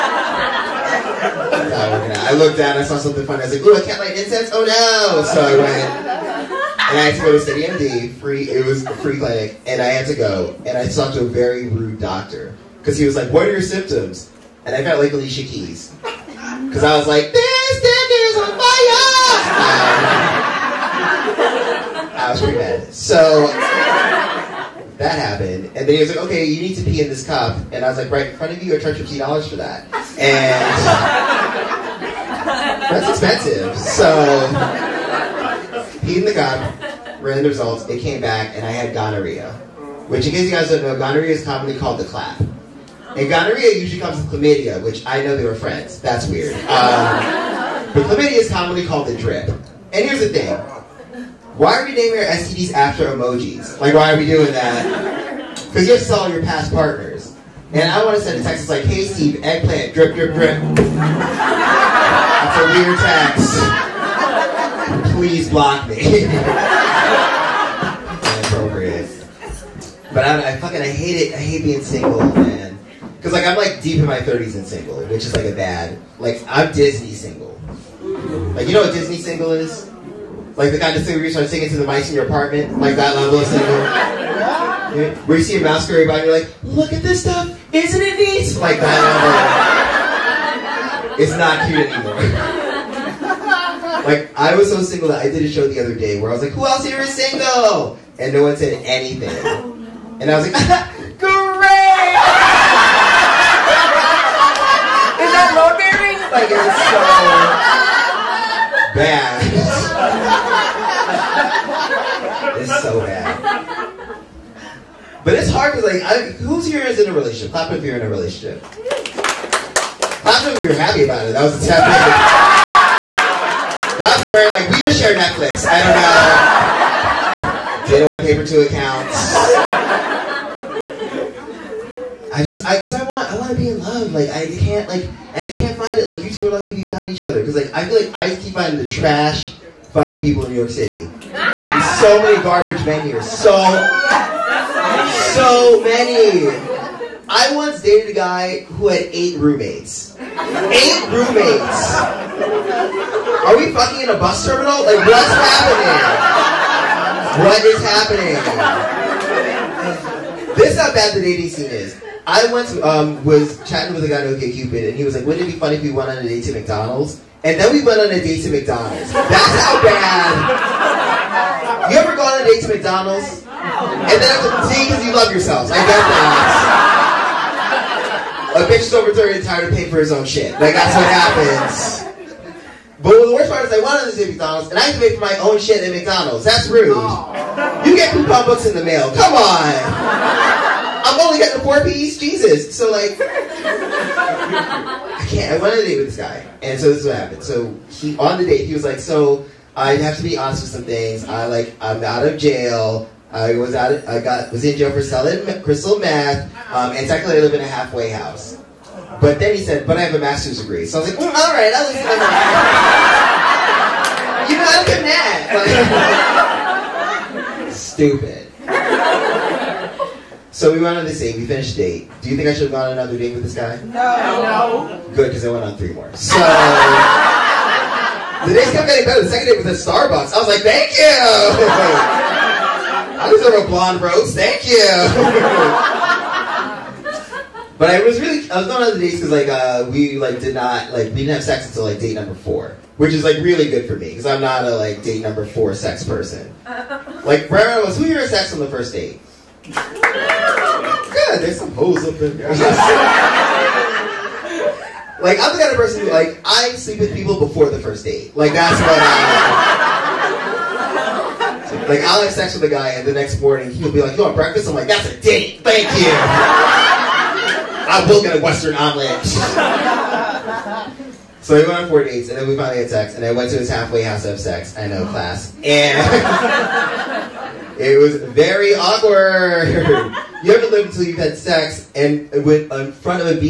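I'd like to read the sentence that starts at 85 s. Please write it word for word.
Where you see a mouse go by and you're like, look at this stuff, isn't it neat?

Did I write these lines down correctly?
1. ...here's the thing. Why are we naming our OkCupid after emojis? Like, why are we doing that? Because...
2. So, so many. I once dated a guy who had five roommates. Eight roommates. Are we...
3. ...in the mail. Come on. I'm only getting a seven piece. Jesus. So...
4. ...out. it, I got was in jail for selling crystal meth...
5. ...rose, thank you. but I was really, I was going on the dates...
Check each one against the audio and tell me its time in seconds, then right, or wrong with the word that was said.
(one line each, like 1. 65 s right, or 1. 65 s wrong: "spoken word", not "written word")
1. 50 s wrong: "STDs", not "OkCupid"
2. 143 s wrong: "eight", not "five"
3. 188 s wrong: "four", not "seven"
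4. 203 s right
5. 233 s right.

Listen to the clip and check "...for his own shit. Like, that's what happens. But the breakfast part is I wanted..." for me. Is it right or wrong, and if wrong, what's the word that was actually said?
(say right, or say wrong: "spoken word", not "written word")
wrong: "worst", not "breakfast".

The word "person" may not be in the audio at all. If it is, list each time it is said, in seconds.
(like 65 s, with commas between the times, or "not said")
246 s, 255 s.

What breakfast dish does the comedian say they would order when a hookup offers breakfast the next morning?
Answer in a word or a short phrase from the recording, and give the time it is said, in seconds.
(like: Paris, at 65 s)
Western omelet, at 268 s.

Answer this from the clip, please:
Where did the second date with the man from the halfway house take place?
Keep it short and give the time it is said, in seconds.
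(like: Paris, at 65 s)
Starbucks, at 229 s.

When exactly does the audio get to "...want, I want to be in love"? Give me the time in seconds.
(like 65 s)
133 s.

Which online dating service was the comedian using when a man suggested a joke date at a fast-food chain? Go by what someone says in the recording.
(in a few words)
OkCupid.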